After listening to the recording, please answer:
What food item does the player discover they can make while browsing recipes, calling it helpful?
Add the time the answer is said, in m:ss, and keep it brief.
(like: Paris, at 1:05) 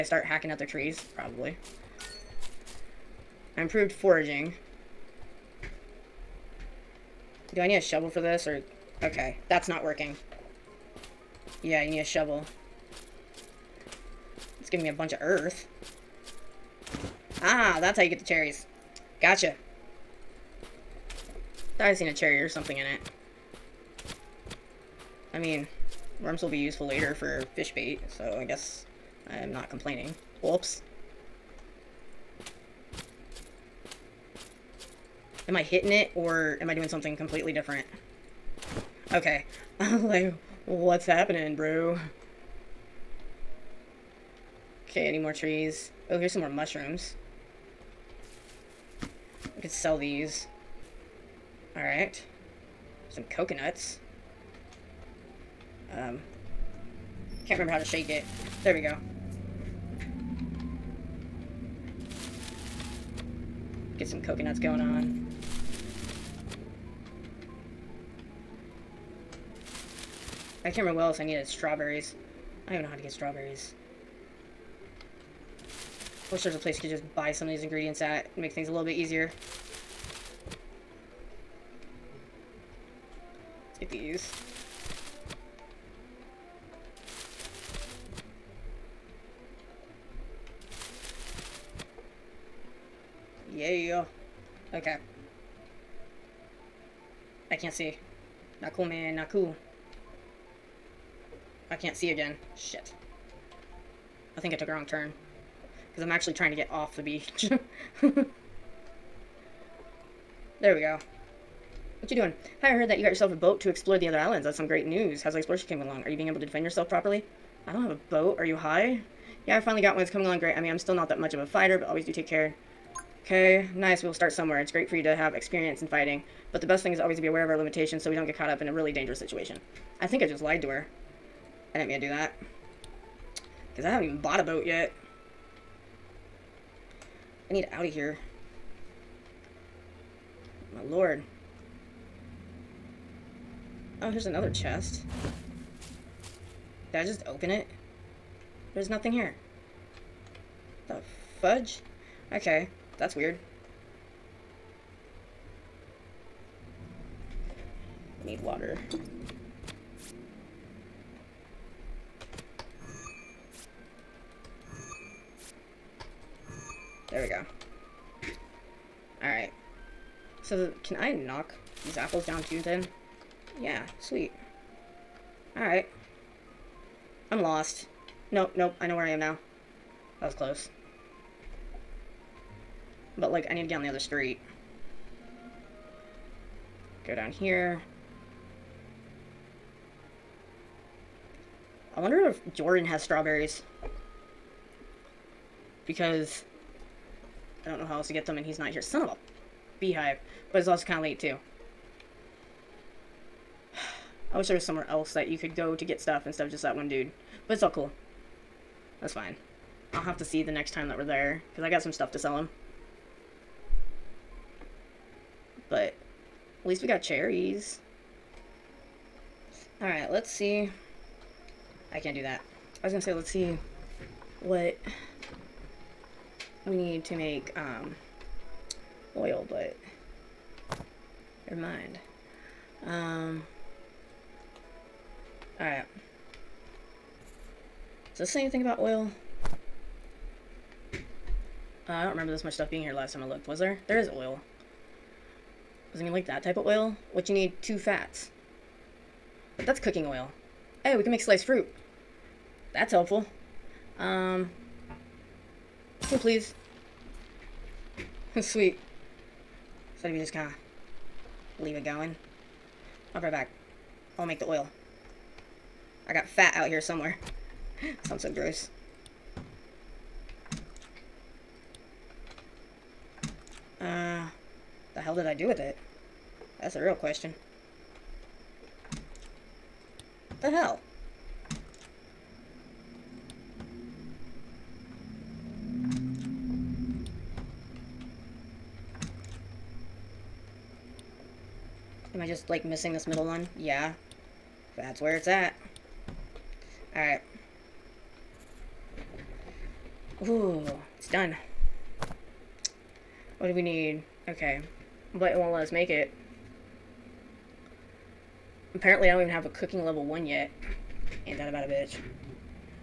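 Sliced fruit, at 4:11.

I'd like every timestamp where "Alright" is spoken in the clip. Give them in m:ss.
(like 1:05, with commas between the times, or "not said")
0:51, 2:49, 2:55, 3:39, 3:55, 4:56.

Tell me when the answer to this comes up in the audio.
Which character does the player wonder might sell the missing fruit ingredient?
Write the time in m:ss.
3:12.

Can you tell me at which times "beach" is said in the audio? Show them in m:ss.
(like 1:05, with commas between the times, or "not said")
1:47.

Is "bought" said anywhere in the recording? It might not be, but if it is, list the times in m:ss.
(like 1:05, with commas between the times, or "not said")
2:14.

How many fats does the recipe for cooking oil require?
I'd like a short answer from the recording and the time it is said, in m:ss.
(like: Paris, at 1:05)
2, at 4:07.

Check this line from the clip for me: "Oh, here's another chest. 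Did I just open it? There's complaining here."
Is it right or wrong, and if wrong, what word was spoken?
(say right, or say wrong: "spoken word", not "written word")
wrong: "nothing", not "complaining".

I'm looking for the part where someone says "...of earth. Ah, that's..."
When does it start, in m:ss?
0:15.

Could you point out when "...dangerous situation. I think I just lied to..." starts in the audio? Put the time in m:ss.
2:08.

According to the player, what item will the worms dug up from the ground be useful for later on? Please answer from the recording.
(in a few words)
Fish bait.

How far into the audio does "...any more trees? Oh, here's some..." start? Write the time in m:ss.
0:45.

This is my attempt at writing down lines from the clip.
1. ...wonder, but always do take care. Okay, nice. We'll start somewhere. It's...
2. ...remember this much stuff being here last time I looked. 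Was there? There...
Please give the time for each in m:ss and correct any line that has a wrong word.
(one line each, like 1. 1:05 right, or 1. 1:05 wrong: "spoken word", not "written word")
1. 2:01 wrong: "fighter", not "wonder"
2. 4:02 right.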